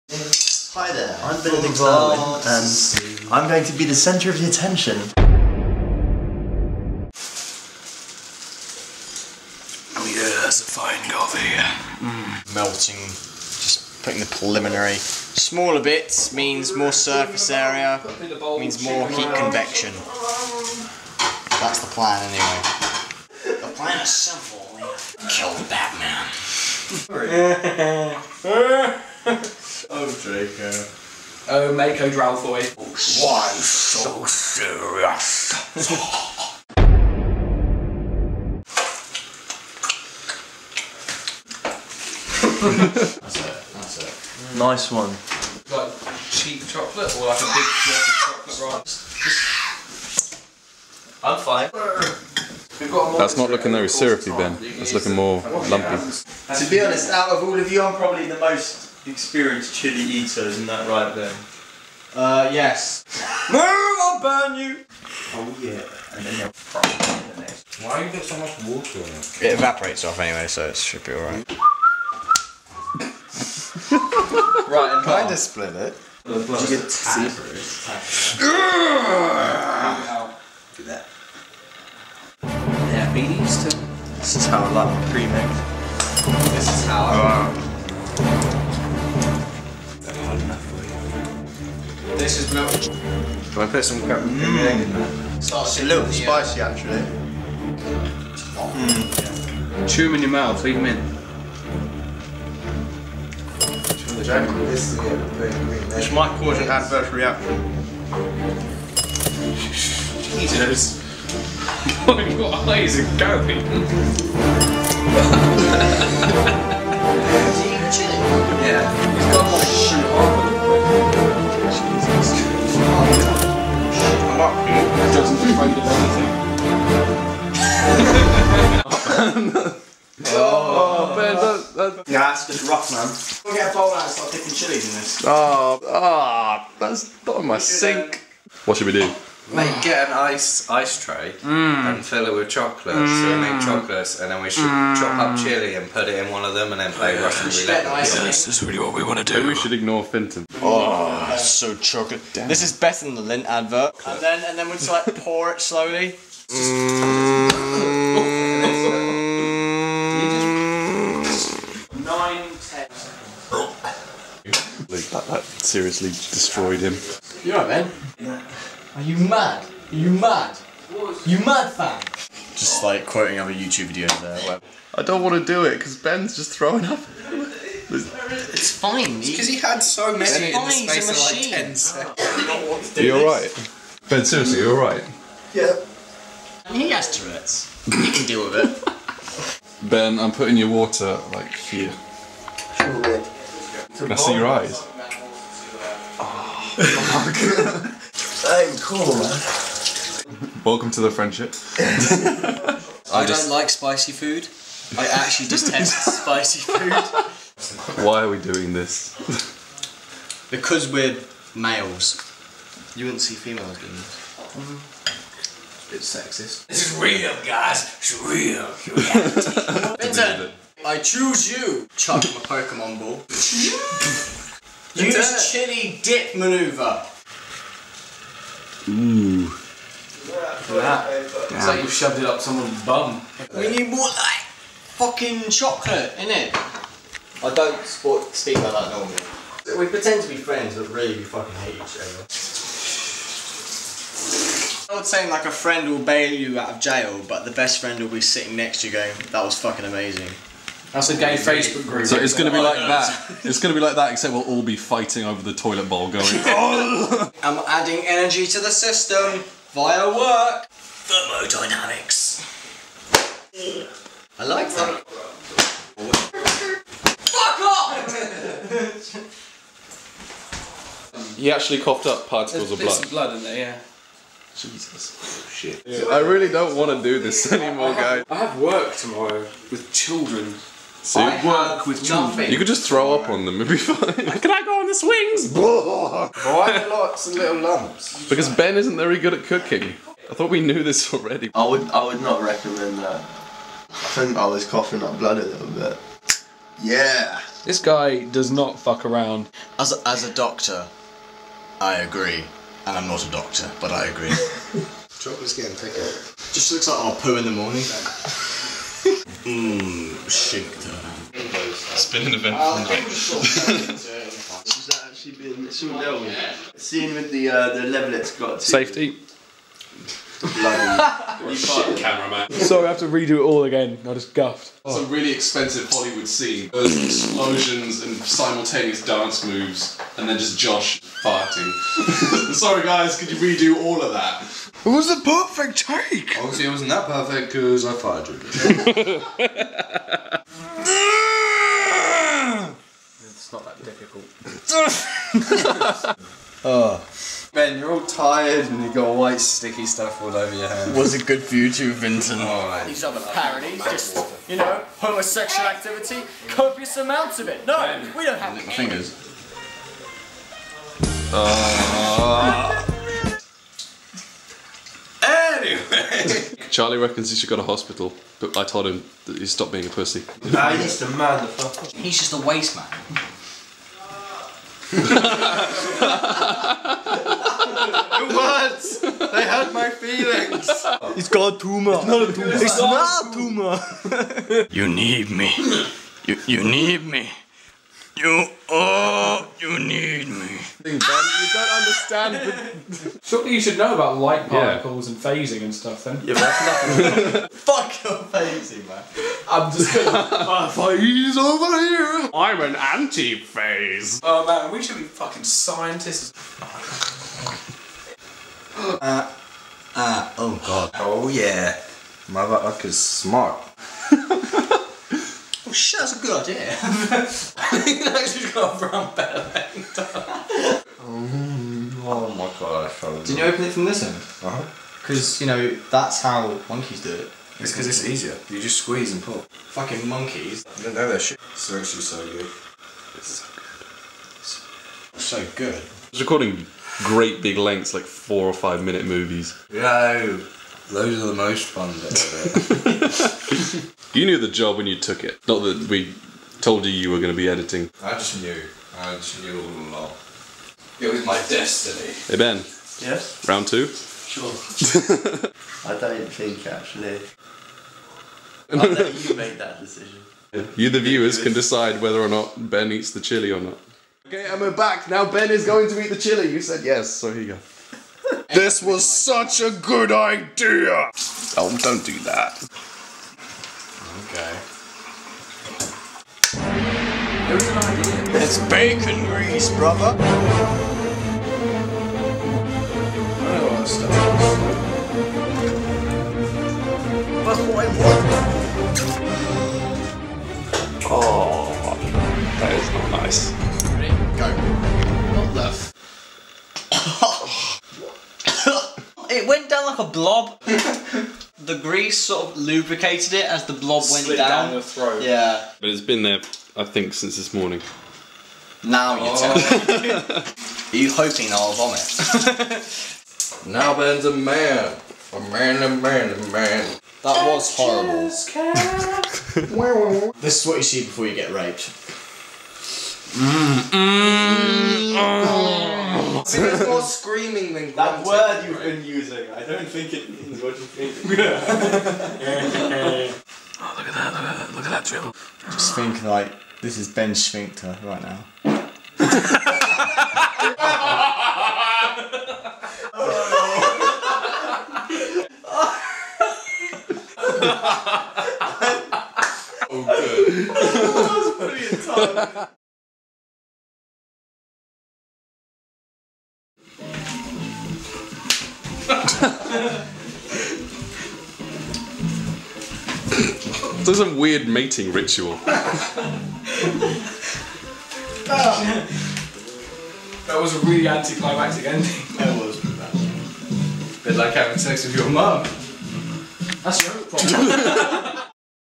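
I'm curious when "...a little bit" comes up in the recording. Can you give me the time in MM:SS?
04:55.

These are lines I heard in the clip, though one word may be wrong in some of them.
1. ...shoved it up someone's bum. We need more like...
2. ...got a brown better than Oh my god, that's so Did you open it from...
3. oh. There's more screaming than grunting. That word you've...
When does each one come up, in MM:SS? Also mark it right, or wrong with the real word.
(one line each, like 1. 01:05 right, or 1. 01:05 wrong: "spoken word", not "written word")
1. 03:51 right
2. 06:58 right
3. 08:45 right.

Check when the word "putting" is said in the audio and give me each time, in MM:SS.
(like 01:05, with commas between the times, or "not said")
00:14, 03:10.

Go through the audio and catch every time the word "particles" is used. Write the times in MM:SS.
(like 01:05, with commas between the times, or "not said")
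04:32, 06:34.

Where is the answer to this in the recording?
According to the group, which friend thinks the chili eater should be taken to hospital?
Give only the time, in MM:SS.
06:06.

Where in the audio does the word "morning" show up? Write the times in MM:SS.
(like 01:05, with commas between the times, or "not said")
05:07, 08:27.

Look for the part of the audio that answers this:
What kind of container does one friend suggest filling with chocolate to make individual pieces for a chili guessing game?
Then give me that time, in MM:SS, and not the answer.
02:20.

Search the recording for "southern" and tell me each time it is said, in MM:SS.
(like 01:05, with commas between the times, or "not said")
not said.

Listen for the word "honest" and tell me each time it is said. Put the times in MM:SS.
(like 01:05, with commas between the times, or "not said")
00:56.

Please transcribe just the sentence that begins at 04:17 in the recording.
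I'm adding energy to the system via work.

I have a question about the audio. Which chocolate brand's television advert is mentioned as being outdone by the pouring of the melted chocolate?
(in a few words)
Lindt.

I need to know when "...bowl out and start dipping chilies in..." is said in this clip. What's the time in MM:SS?
02:13.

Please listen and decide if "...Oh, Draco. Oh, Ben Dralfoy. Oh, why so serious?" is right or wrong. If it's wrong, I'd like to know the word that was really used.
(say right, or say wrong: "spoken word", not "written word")
wrong: "Mako", not "Ben".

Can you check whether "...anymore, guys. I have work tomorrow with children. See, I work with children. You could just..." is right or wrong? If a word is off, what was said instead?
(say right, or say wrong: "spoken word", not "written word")
right.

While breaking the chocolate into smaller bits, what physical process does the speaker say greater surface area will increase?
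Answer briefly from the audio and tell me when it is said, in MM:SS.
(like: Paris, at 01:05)
heat convection, at 00:19.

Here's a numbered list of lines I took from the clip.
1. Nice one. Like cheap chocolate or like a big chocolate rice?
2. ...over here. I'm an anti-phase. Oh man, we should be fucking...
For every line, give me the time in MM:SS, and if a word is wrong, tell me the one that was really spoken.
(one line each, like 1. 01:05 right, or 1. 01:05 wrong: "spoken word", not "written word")
1. 00:44 right
2. 06:41 right.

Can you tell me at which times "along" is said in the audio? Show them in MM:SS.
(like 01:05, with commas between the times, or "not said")
07:29.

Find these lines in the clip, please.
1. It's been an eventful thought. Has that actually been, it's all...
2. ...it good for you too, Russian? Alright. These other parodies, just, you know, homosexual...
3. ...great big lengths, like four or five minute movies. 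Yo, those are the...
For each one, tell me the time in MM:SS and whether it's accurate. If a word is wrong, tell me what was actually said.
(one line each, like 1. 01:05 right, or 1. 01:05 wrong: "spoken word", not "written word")
1. 05:11 wrong: "night", not "thought"
2. 05:51 wrong: "Vincent", not "Russian"
3. 07:16 right.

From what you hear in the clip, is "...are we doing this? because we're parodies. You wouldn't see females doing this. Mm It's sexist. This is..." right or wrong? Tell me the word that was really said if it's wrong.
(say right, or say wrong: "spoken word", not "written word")
wrong: "males", not "parodies".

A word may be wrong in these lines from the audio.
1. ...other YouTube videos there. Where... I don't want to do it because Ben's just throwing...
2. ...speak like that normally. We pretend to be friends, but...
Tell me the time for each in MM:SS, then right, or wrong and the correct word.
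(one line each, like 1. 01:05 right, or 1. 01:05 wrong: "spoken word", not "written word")
1. 02:53 right
2. 03:58 right.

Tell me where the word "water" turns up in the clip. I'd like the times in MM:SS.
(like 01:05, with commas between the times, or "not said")
01:08, 03:10.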